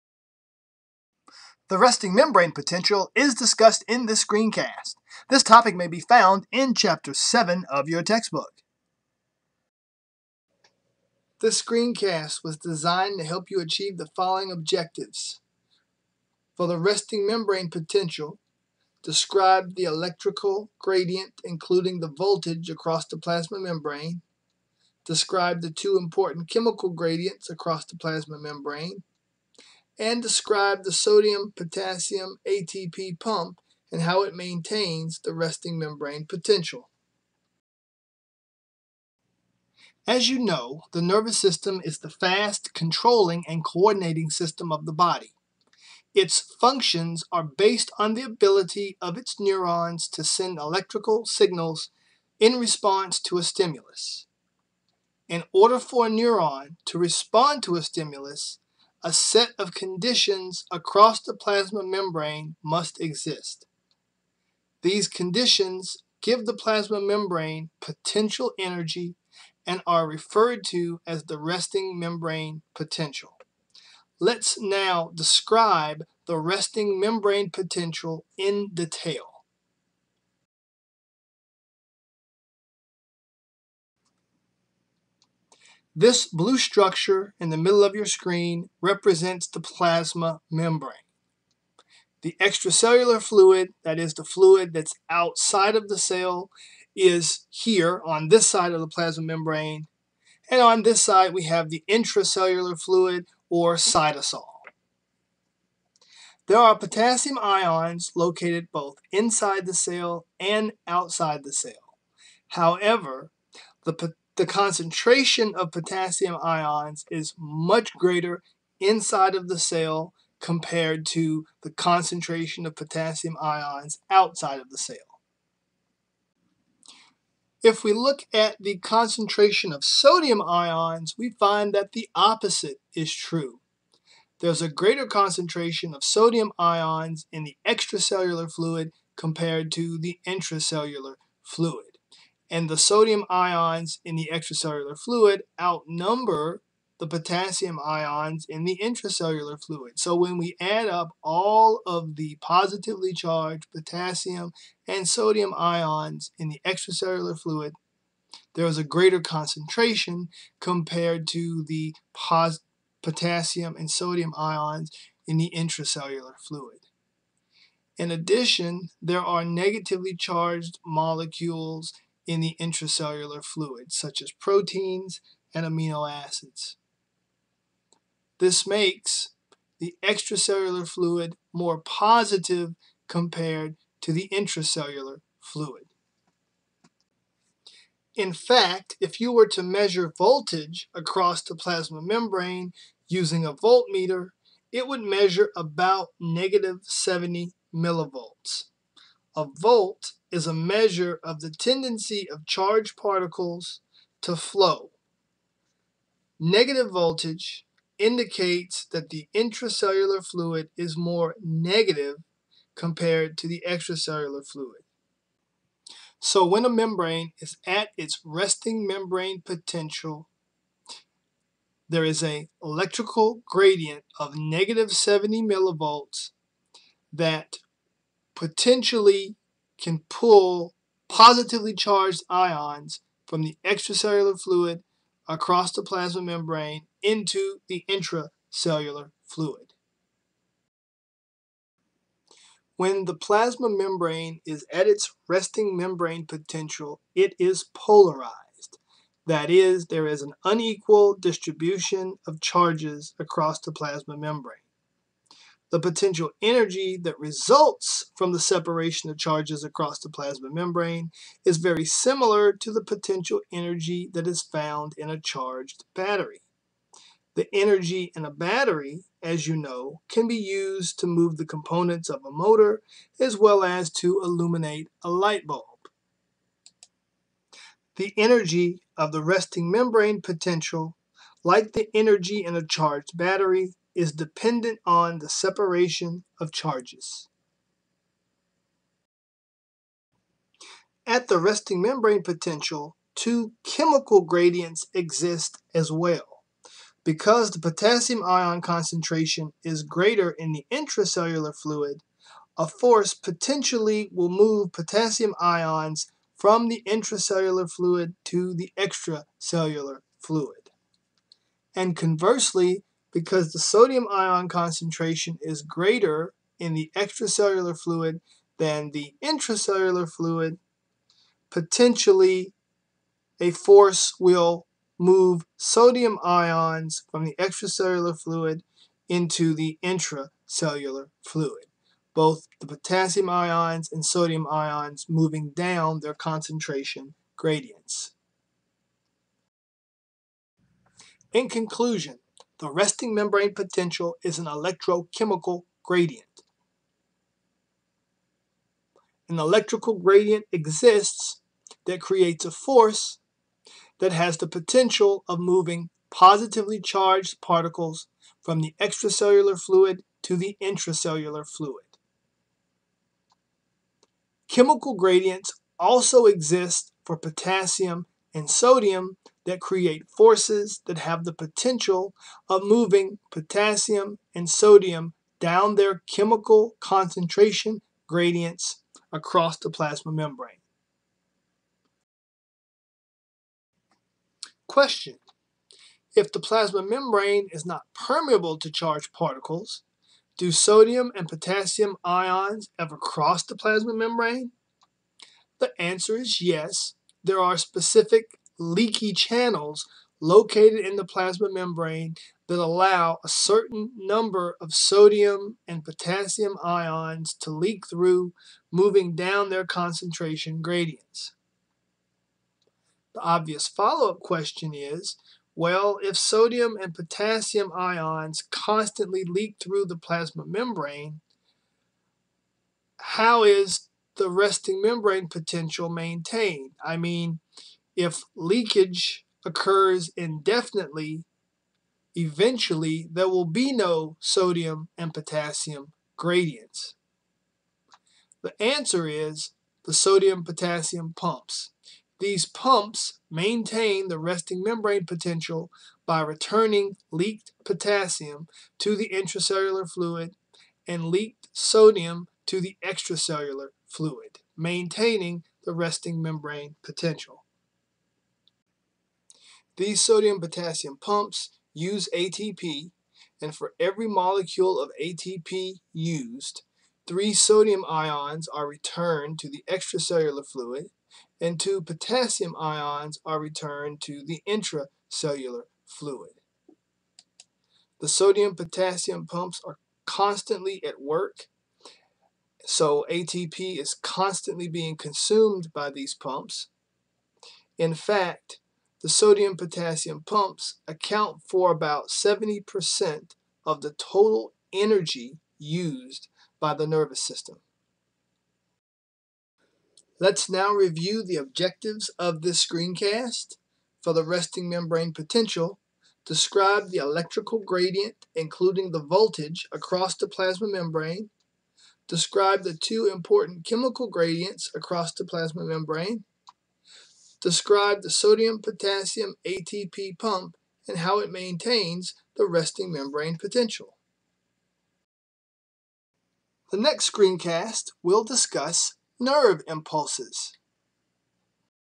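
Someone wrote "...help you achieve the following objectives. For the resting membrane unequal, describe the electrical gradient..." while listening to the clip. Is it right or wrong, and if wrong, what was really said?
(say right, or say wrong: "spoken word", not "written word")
wrong: "potential", not "unequal".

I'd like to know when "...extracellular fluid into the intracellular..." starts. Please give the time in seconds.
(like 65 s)
327 s.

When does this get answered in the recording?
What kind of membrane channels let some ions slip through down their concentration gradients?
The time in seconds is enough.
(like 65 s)
398 s.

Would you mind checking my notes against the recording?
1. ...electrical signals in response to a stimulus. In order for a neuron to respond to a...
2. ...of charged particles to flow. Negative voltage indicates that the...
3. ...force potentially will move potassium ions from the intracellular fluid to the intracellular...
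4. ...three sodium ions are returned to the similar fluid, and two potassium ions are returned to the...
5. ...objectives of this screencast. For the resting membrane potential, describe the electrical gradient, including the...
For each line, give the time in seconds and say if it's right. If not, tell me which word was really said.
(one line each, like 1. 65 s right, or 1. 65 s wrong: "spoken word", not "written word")
1. 50 s right
2. 202 s right
3. 302 s wrong: "extracellular", not "intracellular"
4. 467 s wrong: "extracellular", not "similar"
5. 501 s right.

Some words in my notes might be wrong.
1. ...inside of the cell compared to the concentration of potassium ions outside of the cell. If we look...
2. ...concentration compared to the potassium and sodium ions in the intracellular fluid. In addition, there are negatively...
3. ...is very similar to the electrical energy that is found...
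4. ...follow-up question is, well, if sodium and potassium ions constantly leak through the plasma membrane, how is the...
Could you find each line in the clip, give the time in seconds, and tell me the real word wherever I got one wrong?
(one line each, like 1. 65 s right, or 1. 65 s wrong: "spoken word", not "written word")
1. 118 s right
2. 159 s right
3. 261 s wrong: "potential", not "electrical"
4. 413 s right.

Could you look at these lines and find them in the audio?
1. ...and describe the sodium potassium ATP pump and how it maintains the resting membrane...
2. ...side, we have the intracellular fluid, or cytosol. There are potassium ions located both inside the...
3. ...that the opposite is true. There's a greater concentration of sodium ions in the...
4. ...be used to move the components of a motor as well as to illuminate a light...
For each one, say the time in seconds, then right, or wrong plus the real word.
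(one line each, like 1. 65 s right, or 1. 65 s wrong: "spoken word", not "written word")
1. 30 s right
2. 101 s right
3. 131 s right
4. 270 s right.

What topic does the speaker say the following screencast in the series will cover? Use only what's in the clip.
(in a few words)
nerve impulses.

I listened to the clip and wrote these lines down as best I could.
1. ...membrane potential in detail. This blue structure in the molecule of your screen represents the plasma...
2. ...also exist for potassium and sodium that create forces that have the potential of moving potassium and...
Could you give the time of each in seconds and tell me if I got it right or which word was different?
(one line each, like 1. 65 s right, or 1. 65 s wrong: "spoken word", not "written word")
1. 76 s wrong: "middle", not "molecule"
2. 365 s right.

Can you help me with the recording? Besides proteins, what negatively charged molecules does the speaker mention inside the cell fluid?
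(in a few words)
amino acids.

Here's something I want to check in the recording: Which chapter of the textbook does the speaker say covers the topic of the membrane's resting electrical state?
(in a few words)
Chapter 7.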